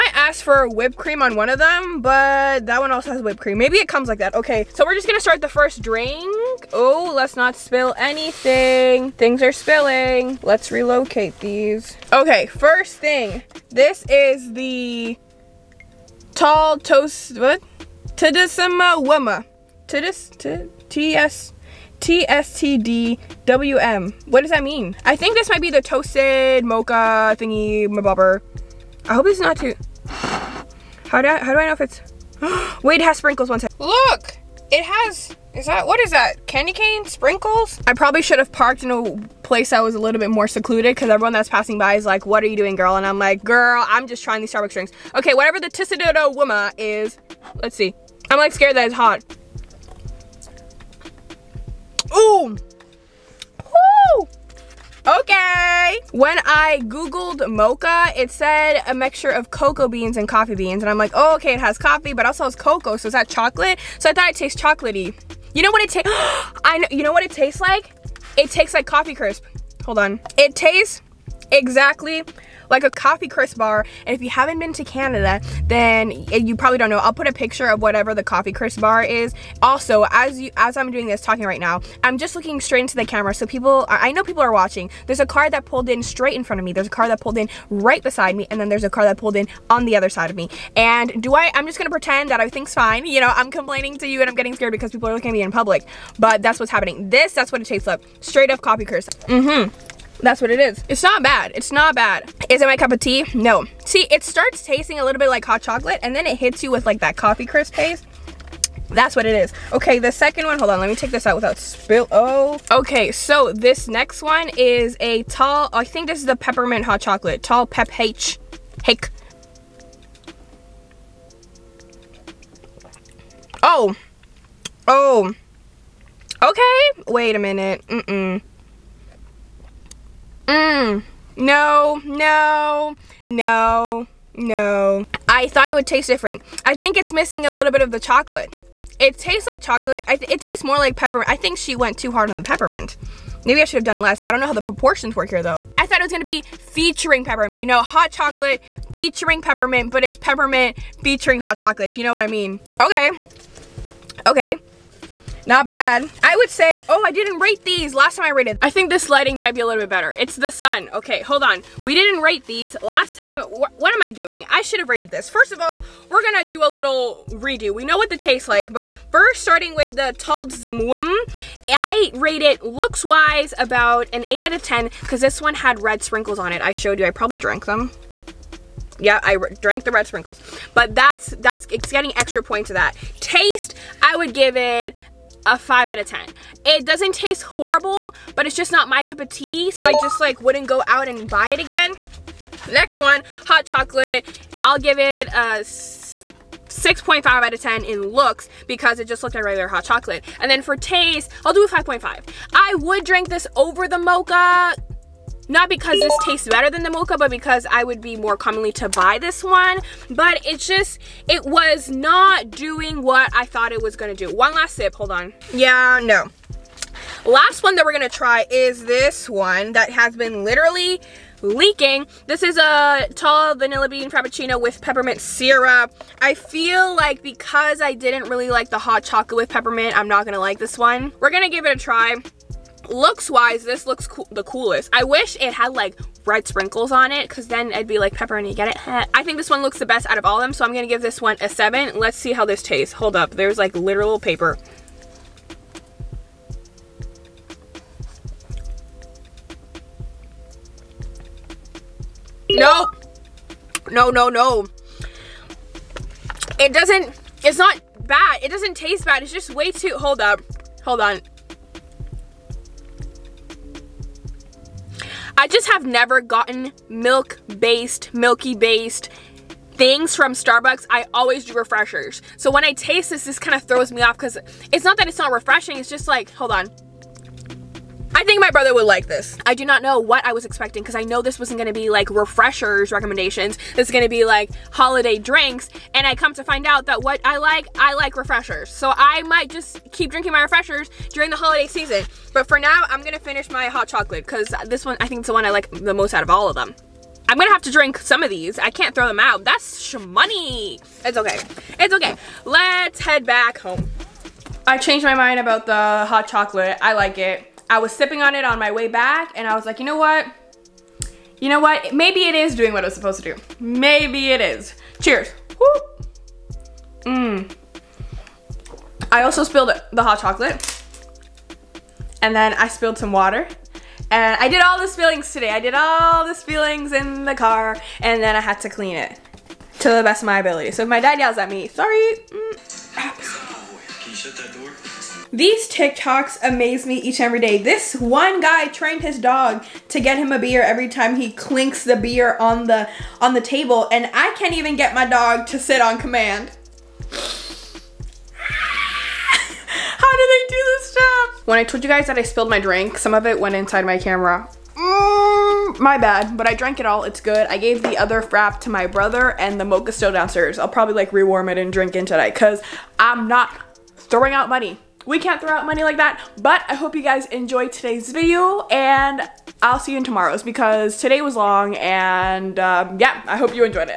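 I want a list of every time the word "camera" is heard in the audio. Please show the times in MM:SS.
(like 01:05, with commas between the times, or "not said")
01:23, 05:53.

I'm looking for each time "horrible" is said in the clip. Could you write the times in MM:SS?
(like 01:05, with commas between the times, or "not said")
03:07.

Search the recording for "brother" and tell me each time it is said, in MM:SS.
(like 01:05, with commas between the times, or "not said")
04:38, 05:58.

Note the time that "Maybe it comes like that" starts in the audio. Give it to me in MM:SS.
00:03.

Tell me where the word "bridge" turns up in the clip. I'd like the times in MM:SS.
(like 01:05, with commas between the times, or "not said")
not said.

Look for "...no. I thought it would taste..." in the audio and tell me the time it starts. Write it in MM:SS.
02:14.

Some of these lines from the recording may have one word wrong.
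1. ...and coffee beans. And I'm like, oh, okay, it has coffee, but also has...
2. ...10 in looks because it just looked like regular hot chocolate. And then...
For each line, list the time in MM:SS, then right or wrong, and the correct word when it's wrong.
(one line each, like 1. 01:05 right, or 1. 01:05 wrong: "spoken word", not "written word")
1. 01:00 right
2. 03:17 right.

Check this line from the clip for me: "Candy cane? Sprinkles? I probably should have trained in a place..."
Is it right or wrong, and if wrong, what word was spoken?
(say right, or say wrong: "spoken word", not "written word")
wrong: "parked", not "trained".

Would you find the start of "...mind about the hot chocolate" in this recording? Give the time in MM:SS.
05:05.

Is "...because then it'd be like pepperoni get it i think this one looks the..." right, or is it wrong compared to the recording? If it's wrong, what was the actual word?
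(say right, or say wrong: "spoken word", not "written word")
right.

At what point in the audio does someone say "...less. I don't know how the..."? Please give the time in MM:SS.
02:24.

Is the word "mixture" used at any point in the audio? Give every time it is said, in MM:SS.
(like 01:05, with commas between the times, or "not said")
00:58.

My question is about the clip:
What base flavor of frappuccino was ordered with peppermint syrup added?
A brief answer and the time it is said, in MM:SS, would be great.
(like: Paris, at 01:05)
Vanilla bean, at 03:43.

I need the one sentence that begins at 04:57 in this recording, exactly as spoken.
I'm gonna have to drink some of these.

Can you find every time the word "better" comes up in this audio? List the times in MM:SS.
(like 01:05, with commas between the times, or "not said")
02:39, 03:26.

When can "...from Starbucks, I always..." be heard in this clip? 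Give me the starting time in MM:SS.
04:30.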